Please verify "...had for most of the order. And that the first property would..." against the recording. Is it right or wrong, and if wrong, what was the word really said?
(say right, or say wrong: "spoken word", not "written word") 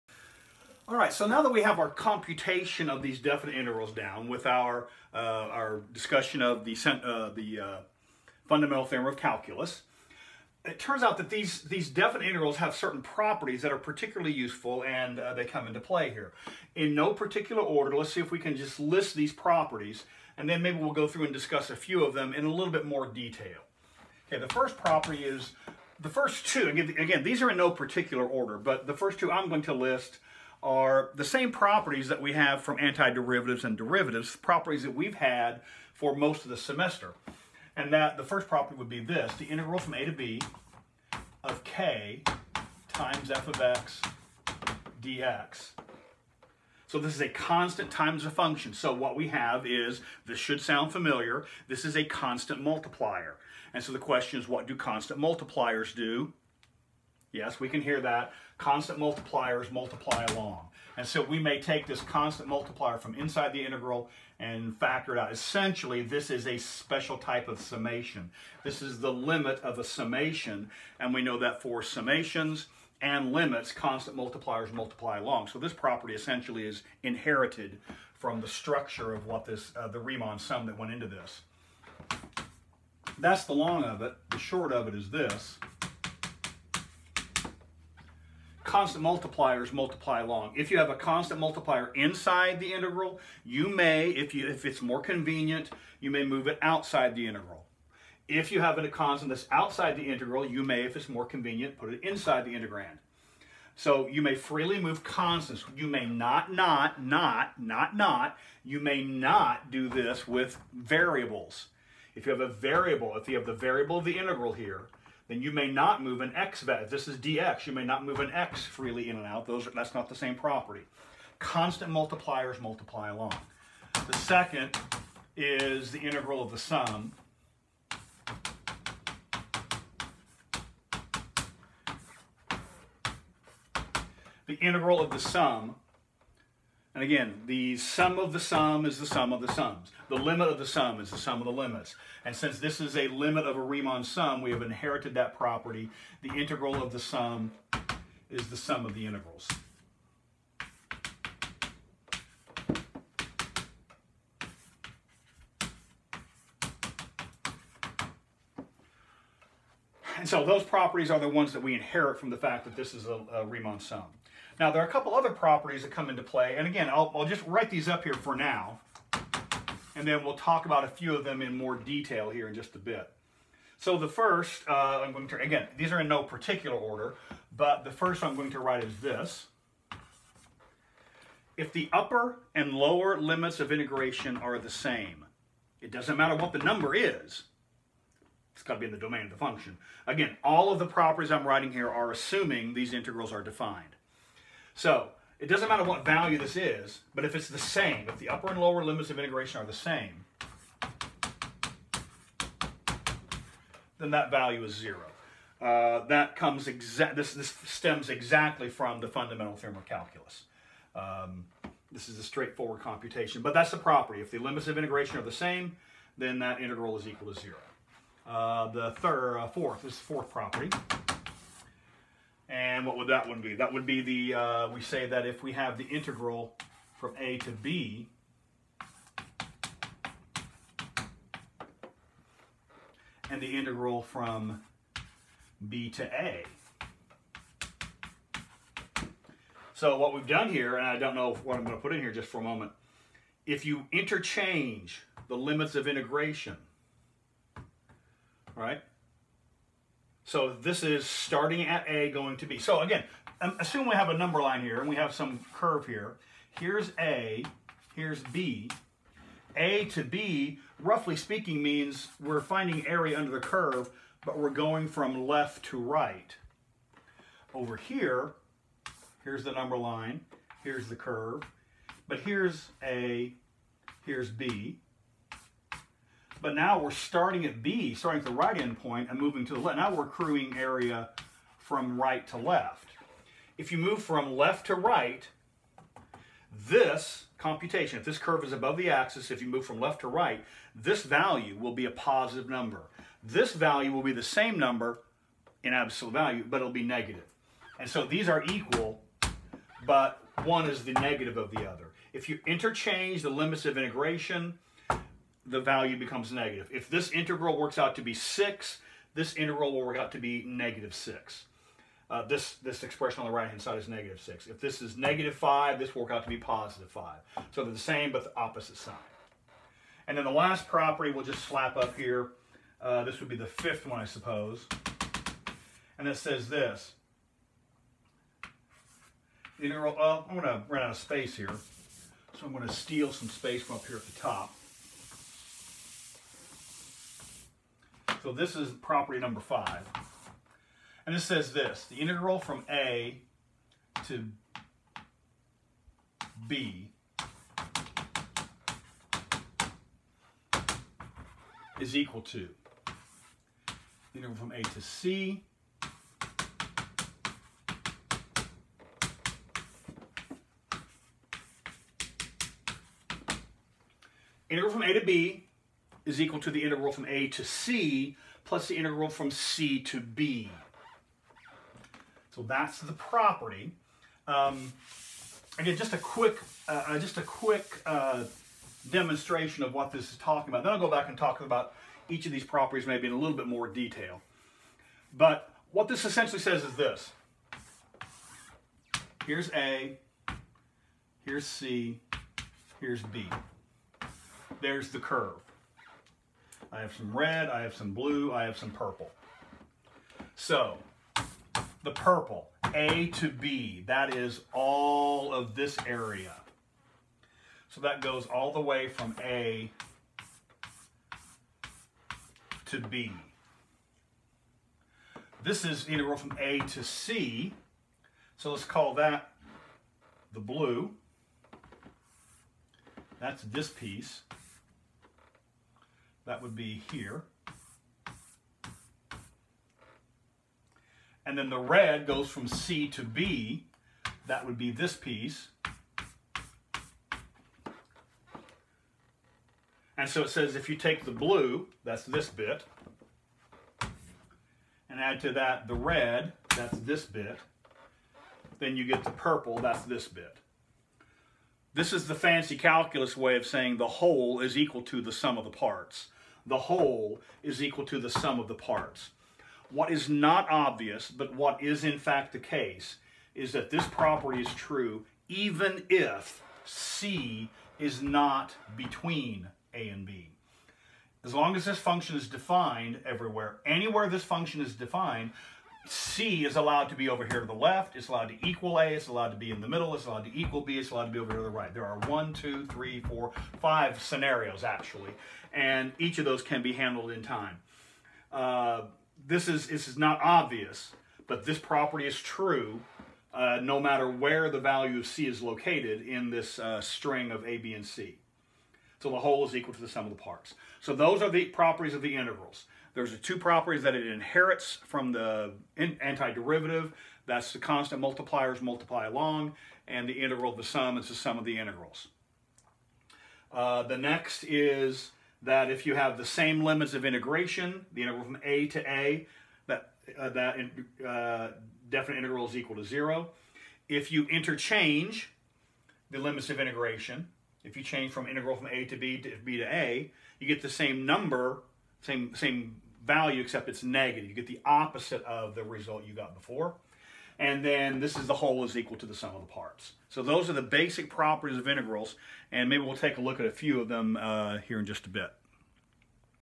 wrong: "semester", not "order".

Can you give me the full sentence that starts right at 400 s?
So, the purple, A to B, that is all of this area.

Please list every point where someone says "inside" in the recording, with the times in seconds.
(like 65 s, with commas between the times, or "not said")
63 s, 91 s, 102 s.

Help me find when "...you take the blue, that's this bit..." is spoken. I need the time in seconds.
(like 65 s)
440 s.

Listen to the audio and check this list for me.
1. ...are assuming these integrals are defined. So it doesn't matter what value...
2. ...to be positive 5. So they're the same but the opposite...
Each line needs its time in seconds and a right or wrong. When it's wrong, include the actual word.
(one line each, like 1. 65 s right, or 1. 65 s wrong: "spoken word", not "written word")
1. 191 s right
2. 316 s right.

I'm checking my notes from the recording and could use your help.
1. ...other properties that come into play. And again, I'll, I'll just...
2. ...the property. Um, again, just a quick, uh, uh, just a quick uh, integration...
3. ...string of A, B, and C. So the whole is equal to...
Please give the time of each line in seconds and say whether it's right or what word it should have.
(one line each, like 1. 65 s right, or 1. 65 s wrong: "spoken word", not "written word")
1. 165 s right
2. 372 s wrong: "demonstration", not "integration"
3. 496 s right.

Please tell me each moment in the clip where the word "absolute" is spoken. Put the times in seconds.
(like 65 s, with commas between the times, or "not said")
295 s.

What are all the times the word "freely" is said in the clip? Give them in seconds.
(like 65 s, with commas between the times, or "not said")
104 s, 118 s.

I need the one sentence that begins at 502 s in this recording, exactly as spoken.
There's the two properties that it inherits from the antiderivative.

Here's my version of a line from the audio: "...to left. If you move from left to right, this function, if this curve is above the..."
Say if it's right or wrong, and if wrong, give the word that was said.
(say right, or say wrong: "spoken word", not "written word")
wrong: "computation", not "function".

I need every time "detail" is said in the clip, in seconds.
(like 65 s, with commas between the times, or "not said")
23 s, 171 s, 383 s.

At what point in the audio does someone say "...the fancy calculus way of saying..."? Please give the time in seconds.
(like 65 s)
452 s.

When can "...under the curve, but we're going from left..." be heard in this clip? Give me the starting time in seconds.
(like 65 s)
263 s.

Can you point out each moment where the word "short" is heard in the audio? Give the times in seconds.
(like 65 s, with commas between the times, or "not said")
84 s.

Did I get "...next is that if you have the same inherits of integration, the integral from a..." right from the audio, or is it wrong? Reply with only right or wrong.
wrong.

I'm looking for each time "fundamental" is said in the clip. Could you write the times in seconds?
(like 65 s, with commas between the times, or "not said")
8 s, 209 s.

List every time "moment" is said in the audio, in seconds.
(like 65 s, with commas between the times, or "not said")
242 s.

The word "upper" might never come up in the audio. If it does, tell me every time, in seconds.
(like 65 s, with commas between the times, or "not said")
181 s, 198 s.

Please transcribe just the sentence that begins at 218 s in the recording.
Uh, the third, uh, fourth, this is the fourth property.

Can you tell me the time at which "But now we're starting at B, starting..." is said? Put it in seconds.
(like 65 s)
276 s.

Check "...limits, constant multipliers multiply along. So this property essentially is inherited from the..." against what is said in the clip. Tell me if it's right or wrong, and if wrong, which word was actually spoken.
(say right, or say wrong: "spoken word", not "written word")
right.